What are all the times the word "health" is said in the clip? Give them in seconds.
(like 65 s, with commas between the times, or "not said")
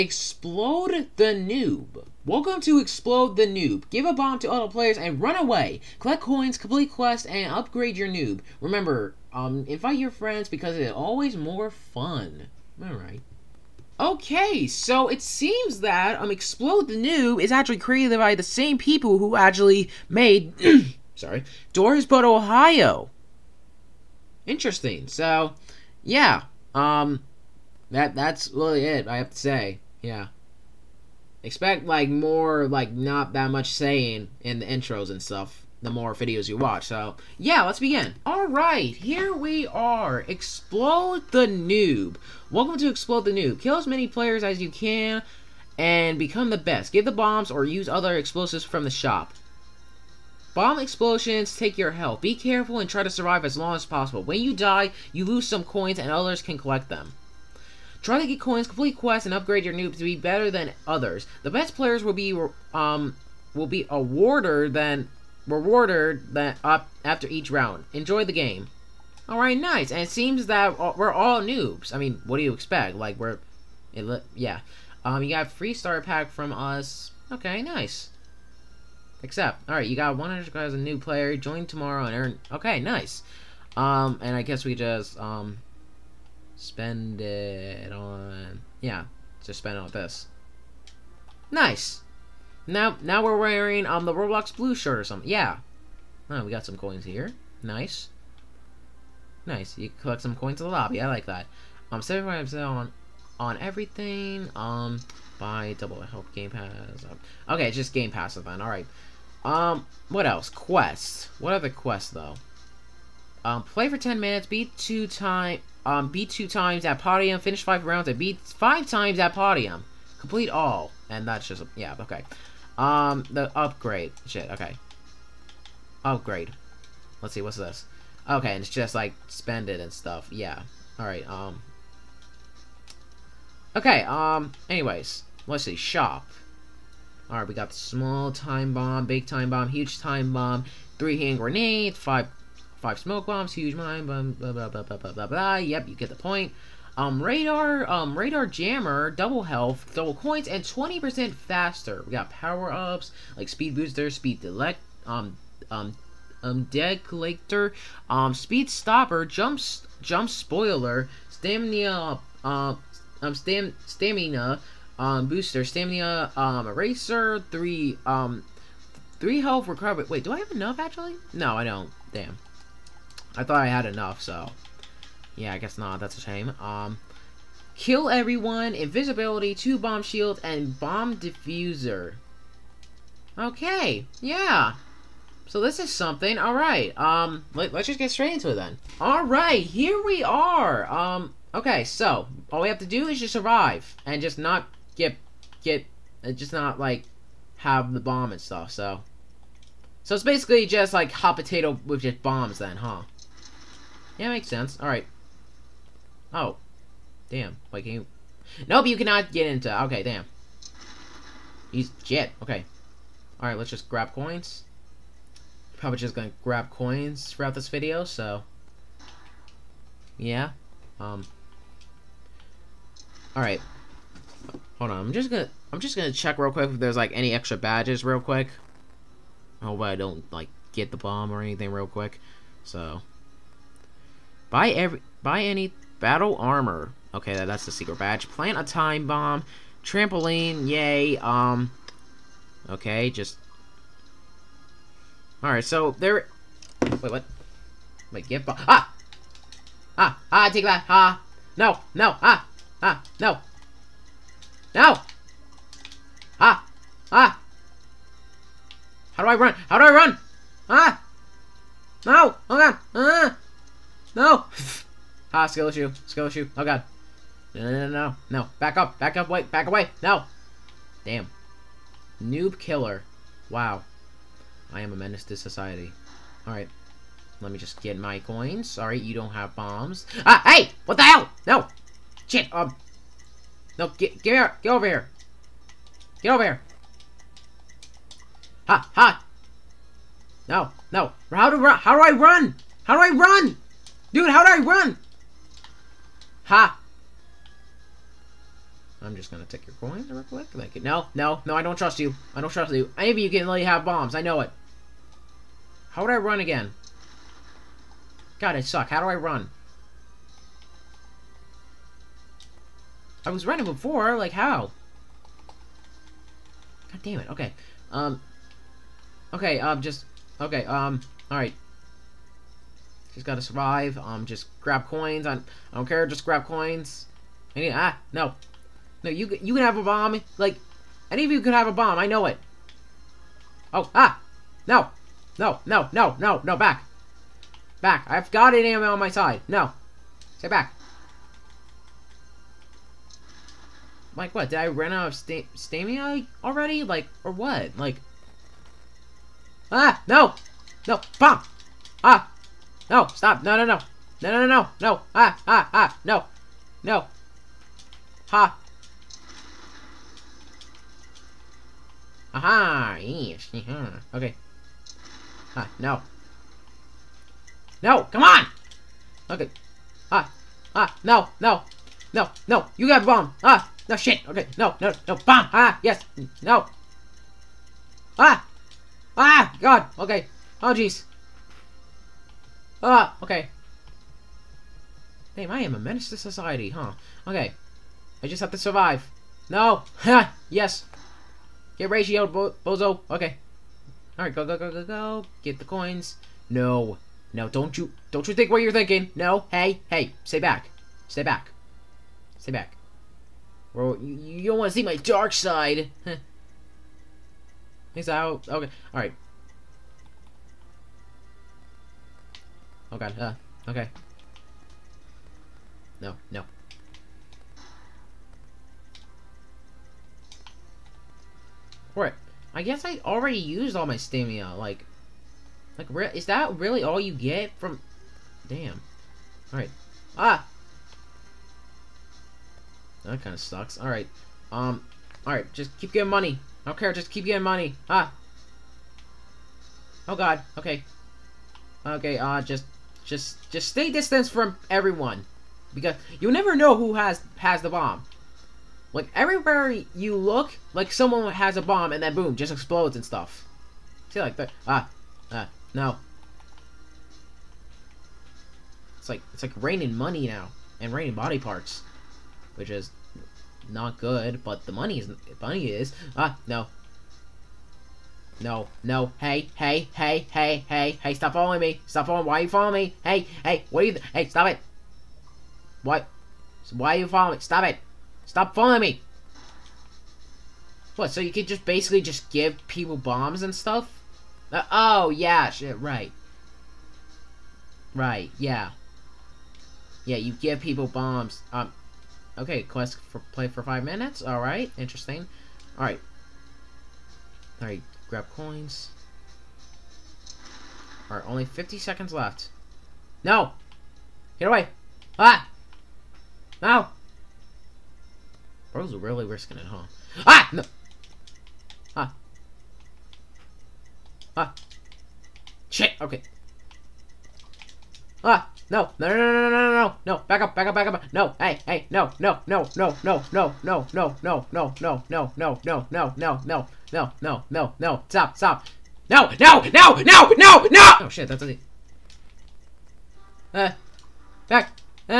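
51 s, 149 s, 169 s.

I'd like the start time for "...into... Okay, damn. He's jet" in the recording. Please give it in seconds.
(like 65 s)
209 s.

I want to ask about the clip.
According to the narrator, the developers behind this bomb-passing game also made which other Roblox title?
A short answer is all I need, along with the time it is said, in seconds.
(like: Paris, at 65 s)
Doors But Ohio, at 21 s.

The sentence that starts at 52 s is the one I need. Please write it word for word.
Be careful and try to survive as long as possible.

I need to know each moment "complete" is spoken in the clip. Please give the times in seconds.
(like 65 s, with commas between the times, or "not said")
6 s, 58 s, 120 s.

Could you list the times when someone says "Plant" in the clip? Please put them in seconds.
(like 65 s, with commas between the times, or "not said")
238 s.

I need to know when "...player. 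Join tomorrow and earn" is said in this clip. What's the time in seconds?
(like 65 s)
80 s.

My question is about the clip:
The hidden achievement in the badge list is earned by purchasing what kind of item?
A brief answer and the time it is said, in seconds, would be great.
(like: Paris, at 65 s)
battle armor, at 235 s.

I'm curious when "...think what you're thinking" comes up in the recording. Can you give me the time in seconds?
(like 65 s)
398 s.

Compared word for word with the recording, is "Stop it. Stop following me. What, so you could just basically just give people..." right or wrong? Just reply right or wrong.
right.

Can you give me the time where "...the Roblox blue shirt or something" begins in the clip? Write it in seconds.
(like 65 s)
94 s.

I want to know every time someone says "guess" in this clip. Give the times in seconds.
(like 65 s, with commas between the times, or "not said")
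84 s, 175 s, 422 s.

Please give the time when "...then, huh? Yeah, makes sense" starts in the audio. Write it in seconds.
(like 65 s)
202 s.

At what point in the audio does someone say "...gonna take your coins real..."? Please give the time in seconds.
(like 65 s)
299 s.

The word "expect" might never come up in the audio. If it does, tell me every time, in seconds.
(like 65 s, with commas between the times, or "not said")
31 s, 72 s.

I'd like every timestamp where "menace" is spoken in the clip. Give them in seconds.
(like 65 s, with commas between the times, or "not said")
274 s, 385 s.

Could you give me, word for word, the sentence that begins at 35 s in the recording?
The more videos you watch, so yeah, let's begin.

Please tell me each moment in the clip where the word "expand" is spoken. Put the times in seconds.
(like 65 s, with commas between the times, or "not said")
not said.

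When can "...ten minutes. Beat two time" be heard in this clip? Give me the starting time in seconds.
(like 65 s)
113 s.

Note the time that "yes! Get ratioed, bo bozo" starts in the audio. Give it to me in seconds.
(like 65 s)
390 s.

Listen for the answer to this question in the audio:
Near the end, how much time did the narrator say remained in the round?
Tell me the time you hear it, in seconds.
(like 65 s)
501 s.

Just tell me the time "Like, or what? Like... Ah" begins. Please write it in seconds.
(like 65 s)
346 s.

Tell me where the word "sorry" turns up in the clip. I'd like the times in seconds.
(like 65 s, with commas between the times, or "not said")
21 s, 278 s.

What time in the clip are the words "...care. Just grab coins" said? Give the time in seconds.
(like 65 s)
325 s.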